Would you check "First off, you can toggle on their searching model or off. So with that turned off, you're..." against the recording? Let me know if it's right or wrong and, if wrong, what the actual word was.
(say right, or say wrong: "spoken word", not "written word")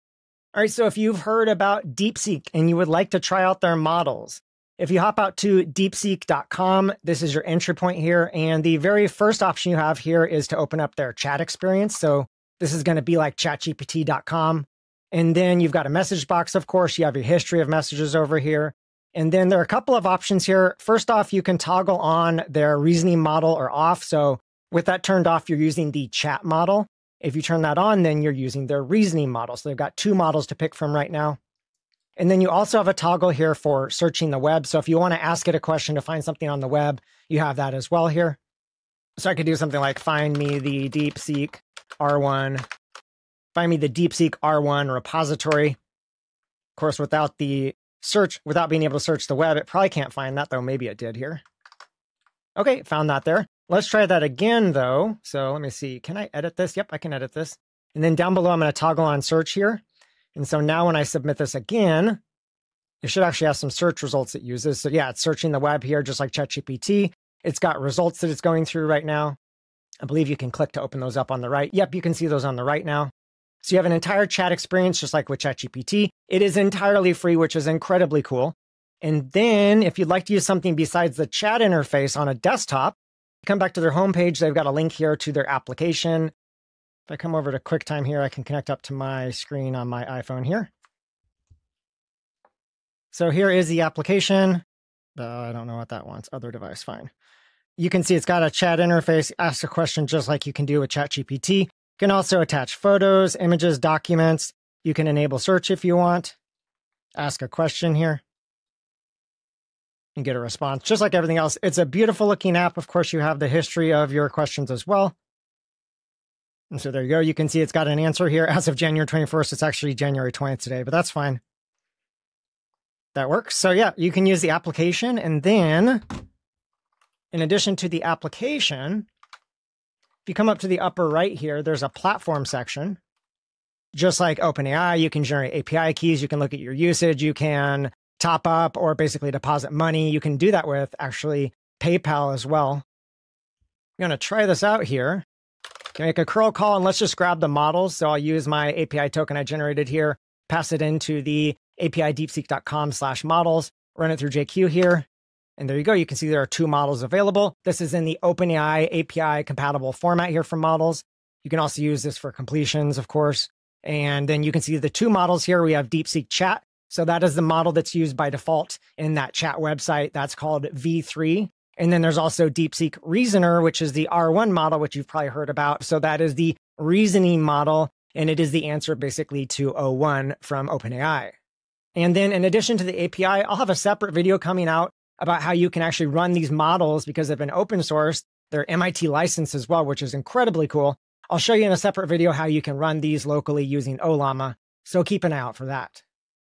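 wrong: "reasoning", not "searching".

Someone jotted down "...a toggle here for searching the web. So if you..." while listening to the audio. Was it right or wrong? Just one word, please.
right.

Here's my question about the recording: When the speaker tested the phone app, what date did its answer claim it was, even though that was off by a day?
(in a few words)
January 21st.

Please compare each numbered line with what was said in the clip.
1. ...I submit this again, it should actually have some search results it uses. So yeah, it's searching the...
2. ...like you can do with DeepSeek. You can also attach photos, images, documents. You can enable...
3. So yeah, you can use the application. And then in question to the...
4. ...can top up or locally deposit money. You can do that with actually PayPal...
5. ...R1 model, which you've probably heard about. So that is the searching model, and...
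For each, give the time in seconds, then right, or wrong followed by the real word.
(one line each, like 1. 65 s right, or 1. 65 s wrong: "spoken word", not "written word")
1. 60 s right
2. 100 s wrong: "ChatGPT", not "DeepSeek"
3. 123 s wrong: "addition", not "question"
4. 137 s wrong: "basically", not "locally"
5. 174 s wrong: "reasoning", not "searching".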